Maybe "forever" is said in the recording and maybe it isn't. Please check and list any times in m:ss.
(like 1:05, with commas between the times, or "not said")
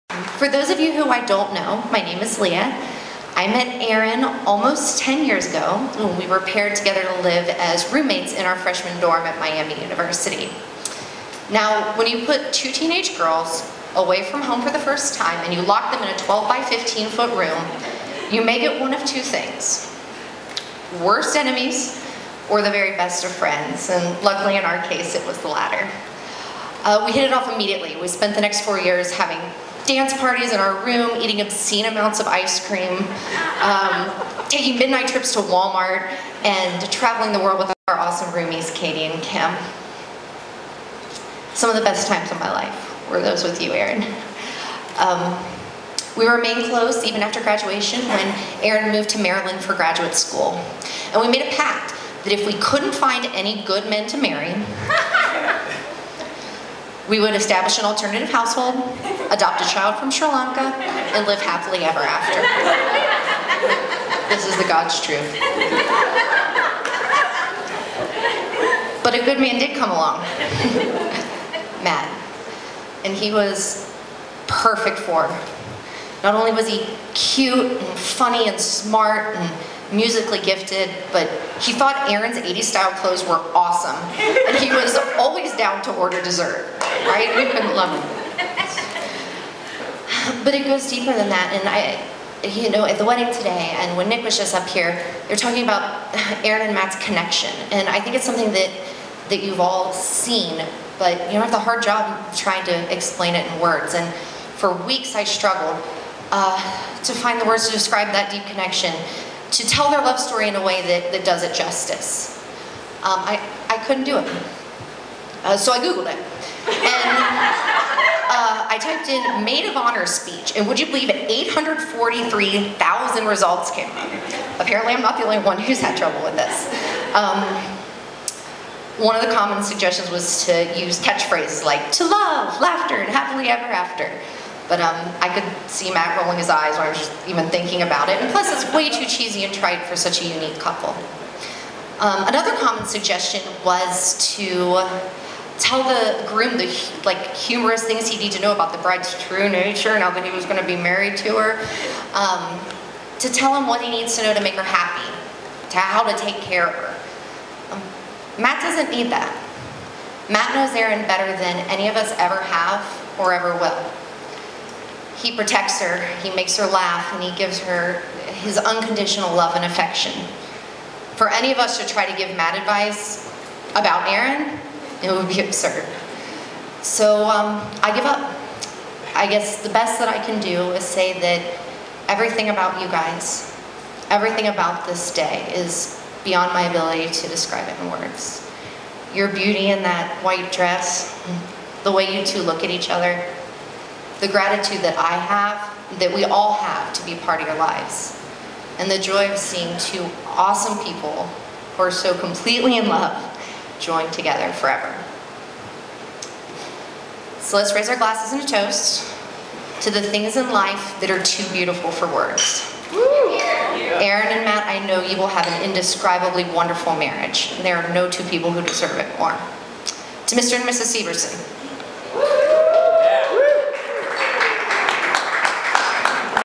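3:24.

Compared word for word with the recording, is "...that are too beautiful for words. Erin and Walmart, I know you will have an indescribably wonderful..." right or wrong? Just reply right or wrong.
wrong.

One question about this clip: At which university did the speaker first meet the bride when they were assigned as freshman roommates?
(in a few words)
Miami University.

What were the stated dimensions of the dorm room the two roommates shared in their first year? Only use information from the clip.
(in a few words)
12 by 15 feet.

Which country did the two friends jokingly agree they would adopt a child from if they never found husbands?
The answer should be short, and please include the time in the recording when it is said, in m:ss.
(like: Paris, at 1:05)
Sri Lanka, at 1:00.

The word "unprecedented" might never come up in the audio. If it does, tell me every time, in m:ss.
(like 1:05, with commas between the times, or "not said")
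not said.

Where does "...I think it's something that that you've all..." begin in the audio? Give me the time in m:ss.
1:37.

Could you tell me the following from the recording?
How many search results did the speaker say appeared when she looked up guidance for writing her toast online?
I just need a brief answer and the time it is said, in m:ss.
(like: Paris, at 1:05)
843,000, at 2:01.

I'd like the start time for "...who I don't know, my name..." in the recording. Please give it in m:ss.
0:00.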